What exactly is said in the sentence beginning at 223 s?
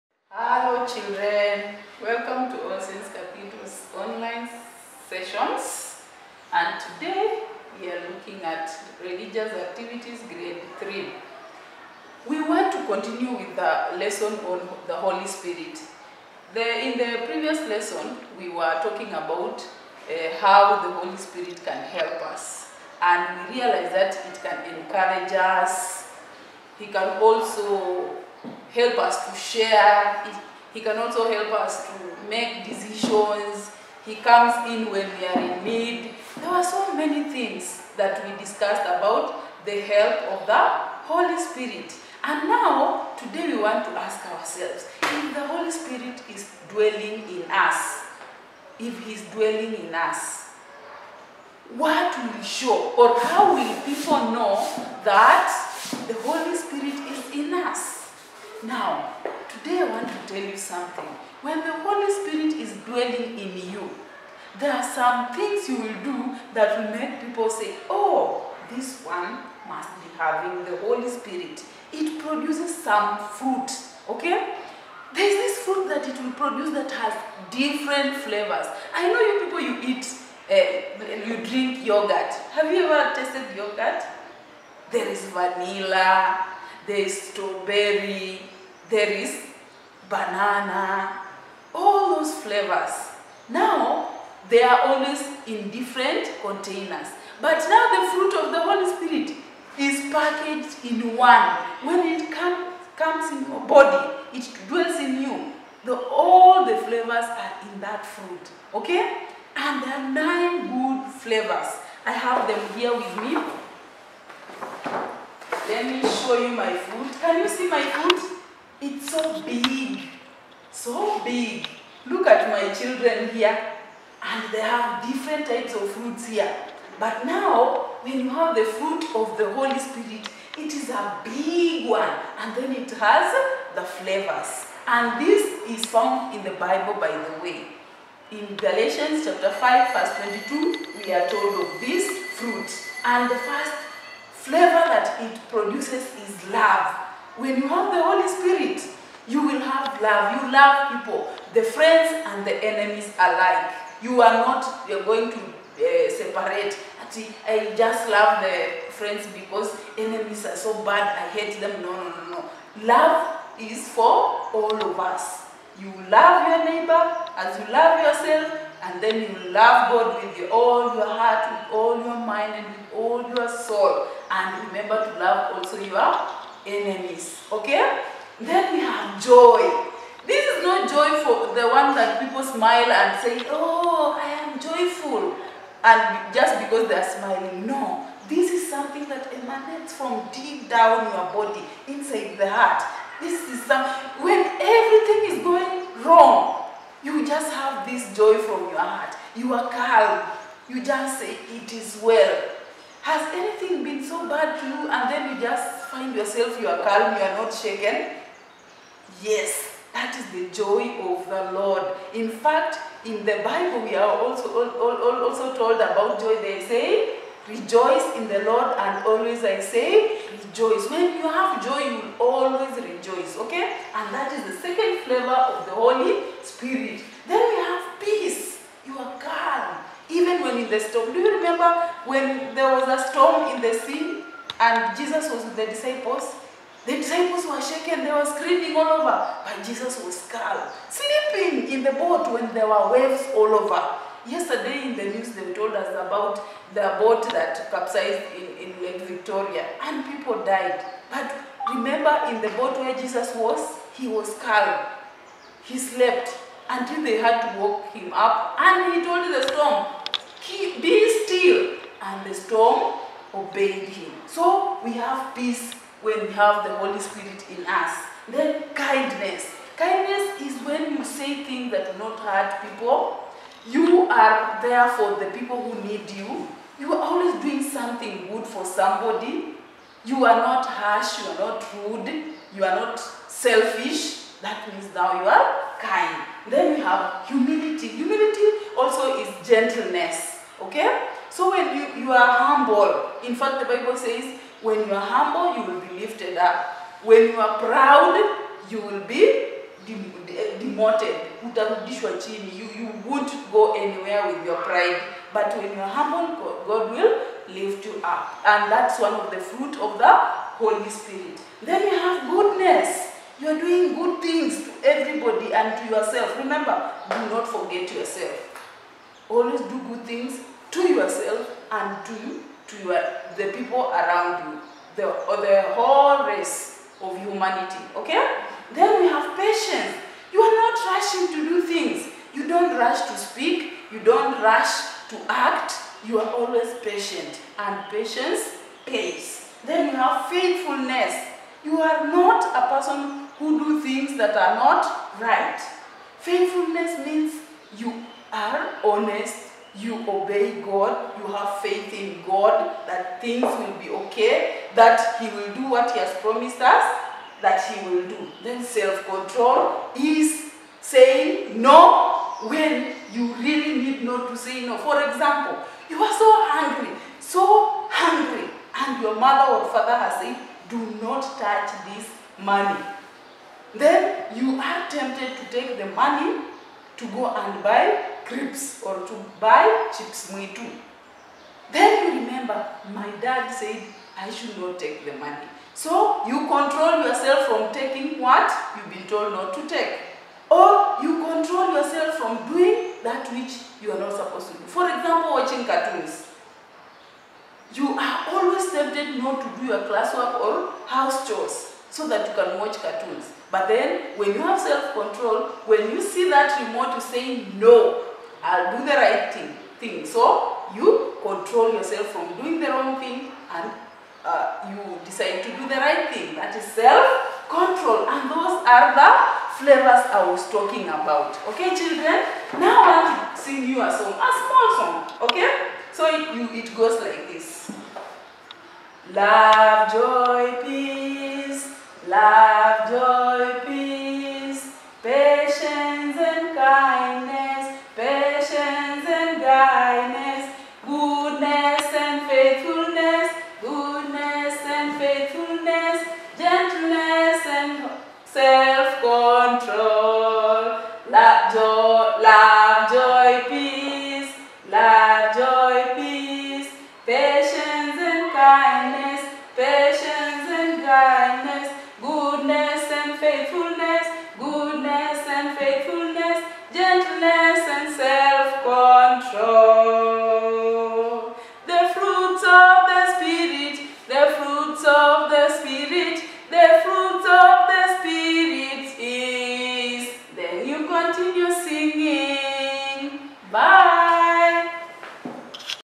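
And that is the second flavor of the Holy Spirit.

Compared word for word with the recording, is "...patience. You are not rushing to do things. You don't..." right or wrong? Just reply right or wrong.
right.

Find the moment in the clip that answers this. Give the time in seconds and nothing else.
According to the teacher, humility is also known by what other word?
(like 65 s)
289 s.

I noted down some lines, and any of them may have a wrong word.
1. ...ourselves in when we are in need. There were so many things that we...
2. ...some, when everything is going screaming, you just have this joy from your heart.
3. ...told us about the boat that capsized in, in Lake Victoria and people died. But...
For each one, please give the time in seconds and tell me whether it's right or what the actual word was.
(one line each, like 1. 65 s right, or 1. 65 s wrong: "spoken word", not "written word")
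1. 34 s wrong: "comes", not "ourselves"
2. 193 s wrong: "wrong", not "screaming"
3. 245 s right.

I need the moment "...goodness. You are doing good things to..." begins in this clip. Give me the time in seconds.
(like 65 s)
312 s.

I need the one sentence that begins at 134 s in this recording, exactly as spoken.
And this is found in the Bible, by the way.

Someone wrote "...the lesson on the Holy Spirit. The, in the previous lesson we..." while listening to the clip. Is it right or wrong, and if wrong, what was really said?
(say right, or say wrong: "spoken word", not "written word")
right.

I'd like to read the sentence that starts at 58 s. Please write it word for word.
Now, Today I want to tell you something.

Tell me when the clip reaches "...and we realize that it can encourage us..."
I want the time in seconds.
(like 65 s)
23 s.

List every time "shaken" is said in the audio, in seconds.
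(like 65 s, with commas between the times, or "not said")
207 s, 237 s.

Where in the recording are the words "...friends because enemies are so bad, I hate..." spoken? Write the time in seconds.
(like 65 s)
158 s.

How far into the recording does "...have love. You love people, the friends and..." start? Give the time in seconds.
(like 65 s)
149 s.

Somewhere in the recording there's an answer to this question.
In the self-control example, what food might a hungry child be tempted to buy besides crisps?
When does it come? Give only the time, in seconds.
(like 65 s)
379 s.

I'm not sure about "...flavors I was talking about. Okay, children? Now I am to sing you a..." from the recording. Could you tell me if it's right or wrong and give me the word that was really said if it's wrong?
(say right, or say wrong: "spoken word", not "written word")
right.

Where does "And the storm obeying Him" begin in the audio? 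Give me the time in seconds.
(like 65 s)
262 s.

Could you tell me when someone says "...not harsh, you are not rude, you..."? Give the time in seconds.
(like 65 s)
280 s.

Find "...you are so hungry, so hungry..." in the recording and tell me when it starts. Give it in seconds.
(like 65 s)
365 s.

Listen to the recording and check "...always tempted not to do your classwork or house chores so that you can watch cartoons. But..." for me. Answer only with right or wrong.
right.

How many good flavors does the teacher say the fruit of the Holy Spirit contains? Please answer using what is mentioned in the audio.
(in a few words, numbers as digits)
9.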